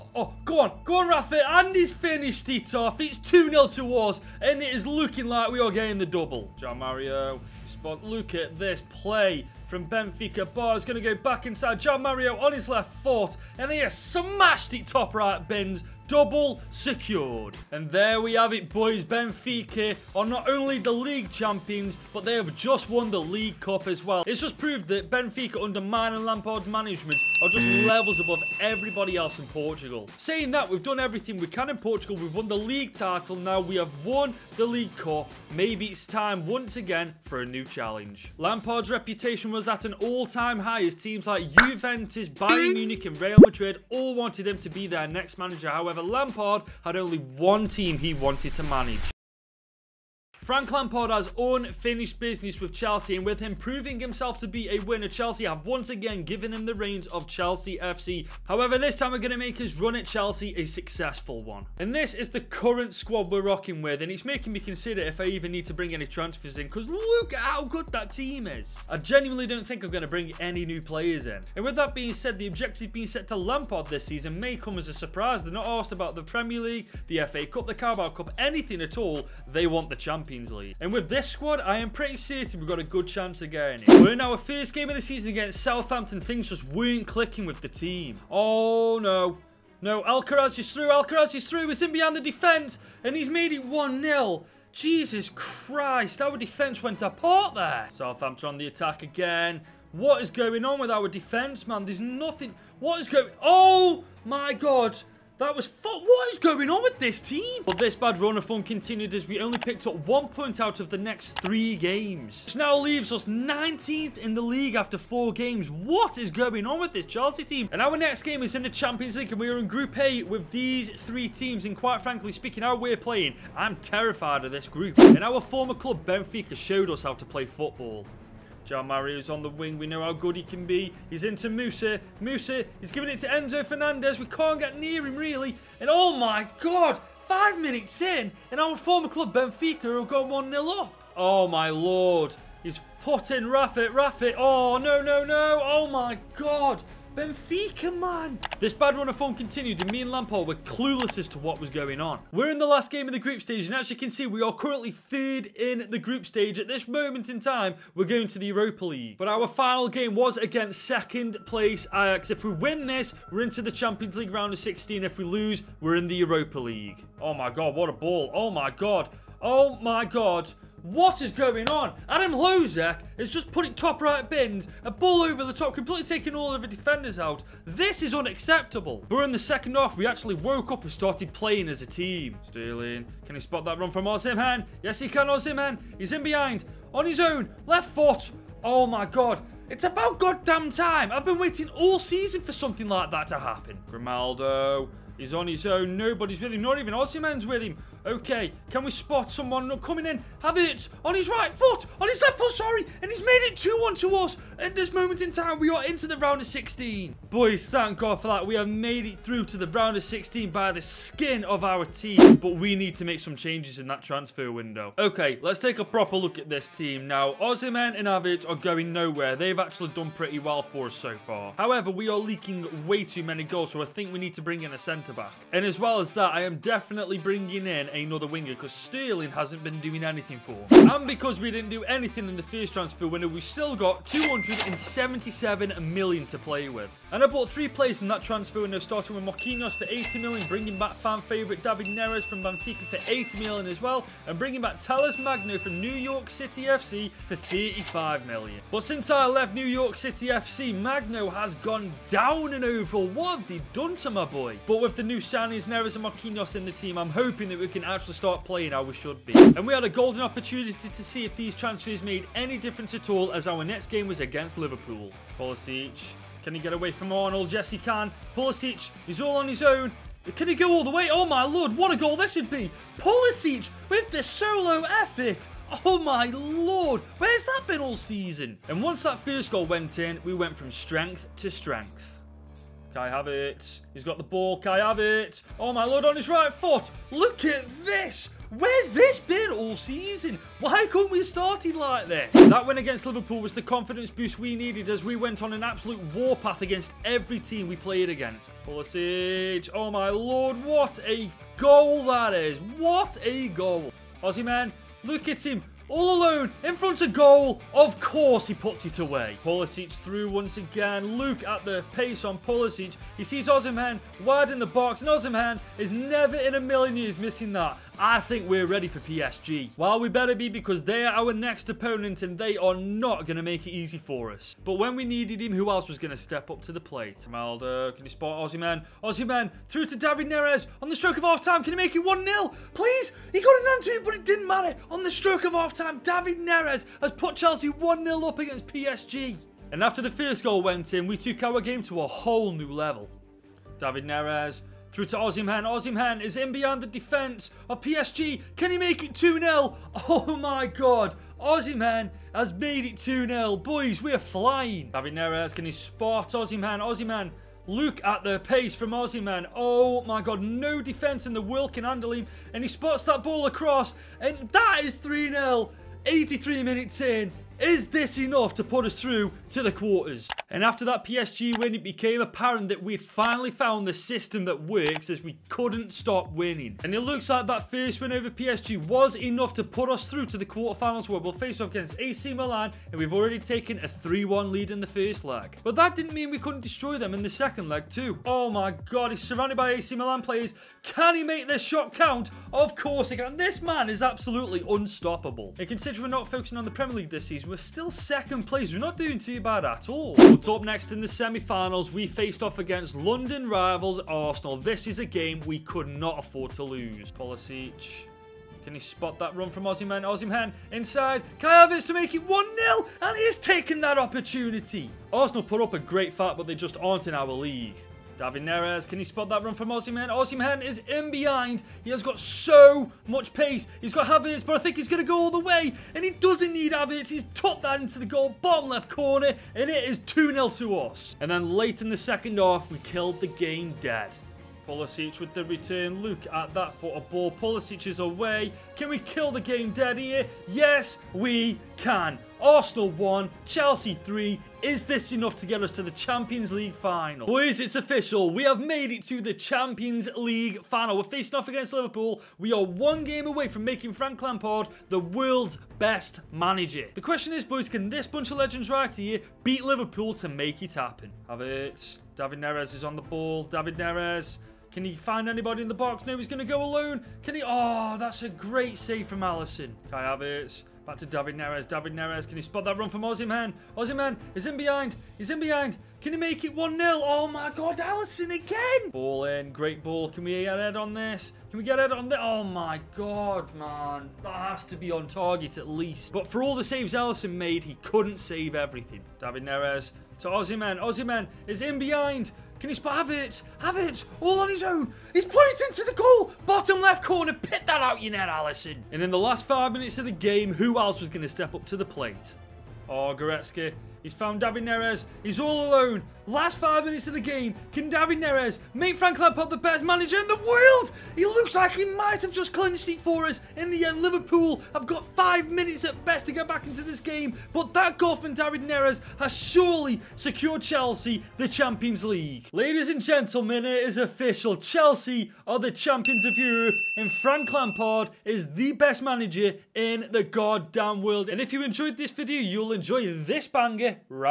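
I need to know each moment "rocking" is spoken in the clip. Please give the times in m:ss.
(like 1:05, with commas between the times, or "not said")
1:03.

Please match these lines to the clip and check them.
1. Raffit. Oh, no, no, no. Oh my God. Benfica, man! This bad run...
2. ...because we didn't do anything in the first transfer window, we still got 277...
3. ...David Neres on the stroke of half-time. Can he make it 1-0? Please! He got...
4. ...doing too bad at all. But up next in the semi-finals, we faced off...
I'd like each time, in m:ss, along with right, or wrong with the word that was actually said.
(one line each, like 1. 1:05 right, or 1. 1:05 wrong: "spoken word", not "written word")
1. 2:23 right
2. 3:51 right
3. 5:29 right
4. 6:38 right.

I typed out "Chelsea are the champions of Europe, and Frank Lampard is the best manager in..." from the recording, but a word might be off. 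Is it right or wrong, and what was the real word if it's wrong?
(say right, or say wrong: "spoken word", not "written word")
right.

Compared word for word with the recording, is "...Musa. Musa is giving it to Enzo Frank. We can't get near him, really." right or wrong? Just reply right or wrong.
wrong.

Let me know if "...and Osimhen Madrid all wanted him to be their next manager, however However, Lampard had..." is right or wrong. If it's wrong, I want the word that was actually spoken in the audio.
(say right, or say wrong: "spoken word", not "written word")
wrong: "Real", not "Osimhen".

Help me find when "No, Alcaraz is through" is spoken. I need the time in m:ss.
1:29.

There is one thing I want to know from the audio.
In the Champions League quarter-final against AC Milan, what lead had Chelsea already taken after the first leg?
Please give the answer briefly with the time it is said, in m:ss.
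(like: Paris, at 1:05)
3-1, at 6:23.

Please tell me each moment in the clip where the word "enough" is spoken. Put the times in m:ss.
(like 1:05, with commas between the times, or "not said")
6:08, 6:19, 7:25.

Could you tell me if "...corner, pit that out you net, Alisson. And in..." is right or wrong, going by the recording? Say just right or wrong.
right.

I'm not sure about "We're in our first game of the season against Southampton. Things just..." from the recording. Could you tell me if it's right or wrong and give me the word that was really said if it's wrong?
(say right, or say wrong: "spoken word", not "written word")
right.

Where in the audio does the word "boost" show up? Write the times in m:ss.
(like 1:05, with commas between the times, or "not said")
4:54.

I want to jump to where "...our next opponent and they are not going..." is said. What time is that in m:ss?
5:21.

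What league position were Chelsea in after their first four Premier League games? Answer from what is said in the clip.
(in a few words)
19th.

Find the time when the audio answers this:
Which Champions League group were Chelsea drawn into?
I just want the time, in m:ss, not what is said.
1:59.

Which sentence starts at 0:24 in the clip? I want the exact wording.
It's just proved that Benfica under Mine and Lampard's management are just mm.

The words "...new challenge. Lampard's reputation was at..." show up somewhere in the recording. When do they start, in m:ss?
0:37.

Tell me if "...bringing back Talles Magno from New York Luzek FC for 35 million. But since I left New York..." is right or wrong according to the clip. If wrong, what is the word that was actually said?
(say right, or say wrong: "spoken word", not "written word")
wrong: "City", not "Luzek".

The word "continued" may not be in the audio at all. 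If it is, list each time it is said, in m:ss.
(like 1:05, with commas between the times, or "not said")
1:48, 2:29.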